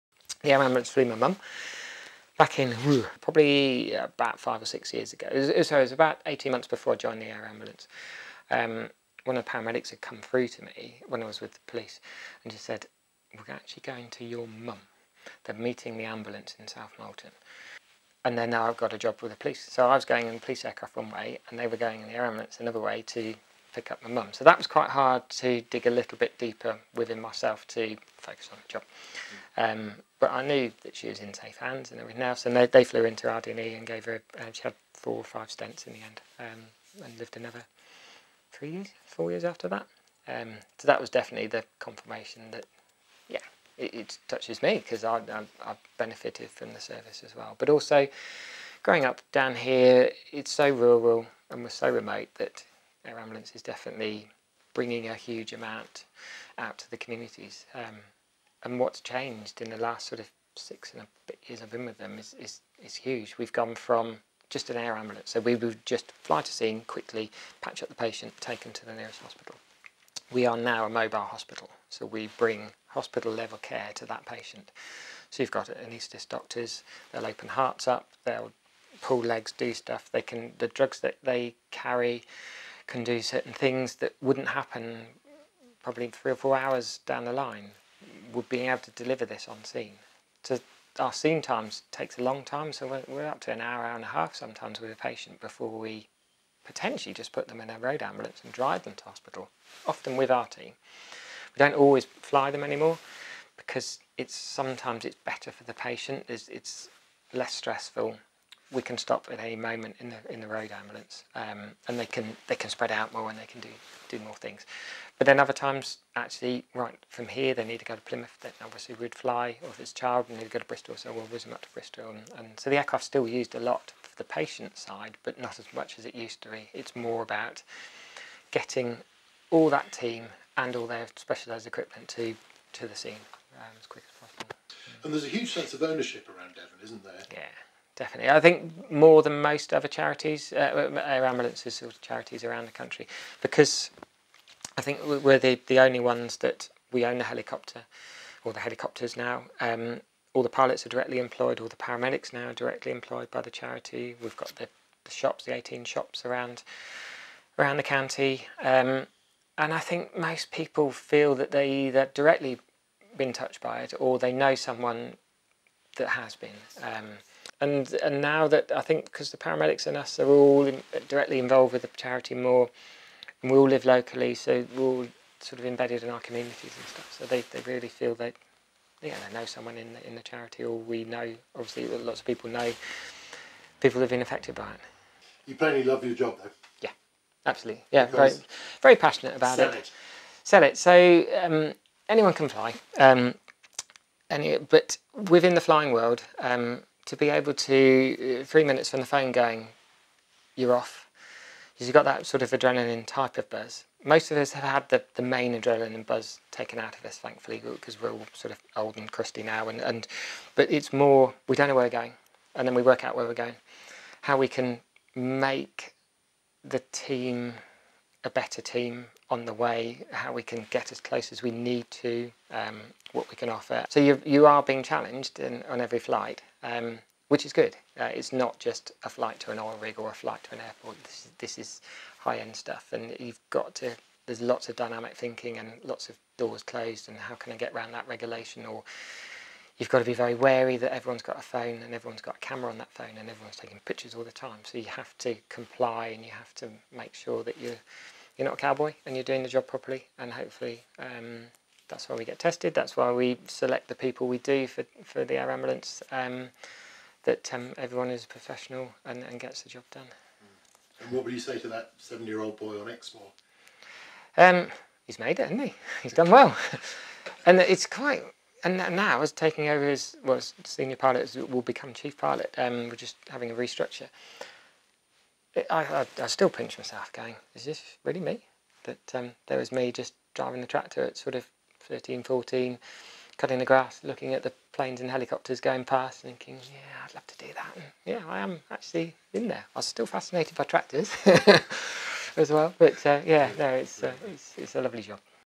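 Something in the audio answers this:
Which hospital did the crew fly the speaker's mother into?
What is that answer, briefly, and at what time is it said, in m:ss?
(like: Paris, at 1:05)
RD&E, at 0:33.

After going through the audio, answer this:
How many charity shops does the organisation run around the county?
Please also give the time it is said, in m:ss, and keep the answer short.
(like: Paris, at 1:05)
18, at 2:35.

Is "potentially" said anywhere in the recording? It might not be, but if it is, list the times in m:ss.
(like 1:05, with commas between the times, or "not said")
1:36.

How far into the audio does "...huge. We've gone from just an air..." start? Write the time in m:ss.
1:02.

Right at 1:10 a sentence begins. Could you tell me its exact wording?
We are now a mobile hospital, so we bring hospital level care to that patient.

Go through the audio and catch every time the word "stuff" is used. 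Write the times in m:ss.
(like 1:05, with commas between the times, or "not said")
1:19, 2:56, 3:52.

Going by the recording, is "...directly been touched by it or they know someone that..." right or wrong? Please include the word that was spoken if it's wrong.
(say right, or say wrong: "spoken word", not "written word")
right.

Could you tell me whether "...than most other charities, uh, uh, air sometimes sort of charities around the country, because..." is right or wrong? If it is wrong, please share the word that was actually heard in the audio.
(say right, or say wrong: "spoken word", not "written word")
wrong: "ambulances", not "sometimes".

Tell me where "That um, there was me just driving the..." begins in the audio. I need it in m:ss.
4:38.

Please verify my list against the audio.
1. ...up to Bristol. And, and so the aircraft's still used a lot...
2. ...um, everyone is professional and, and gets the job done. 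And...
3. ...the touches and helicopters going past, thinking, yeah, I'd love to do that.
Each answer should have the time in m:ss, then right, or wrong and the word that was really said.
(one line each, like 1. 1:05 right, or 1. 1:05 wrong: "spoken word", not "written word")
1. 2:01 right
2. 4:17 right
3. 4:44 wrong: "planes", not "touches".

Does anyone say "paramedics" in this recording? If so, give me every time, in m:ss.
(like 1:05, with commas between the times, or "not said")
0:09, 2:31, 2:49.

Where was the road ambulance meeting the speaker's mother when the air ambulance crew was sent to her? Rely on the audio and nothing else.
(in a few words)
South Molton.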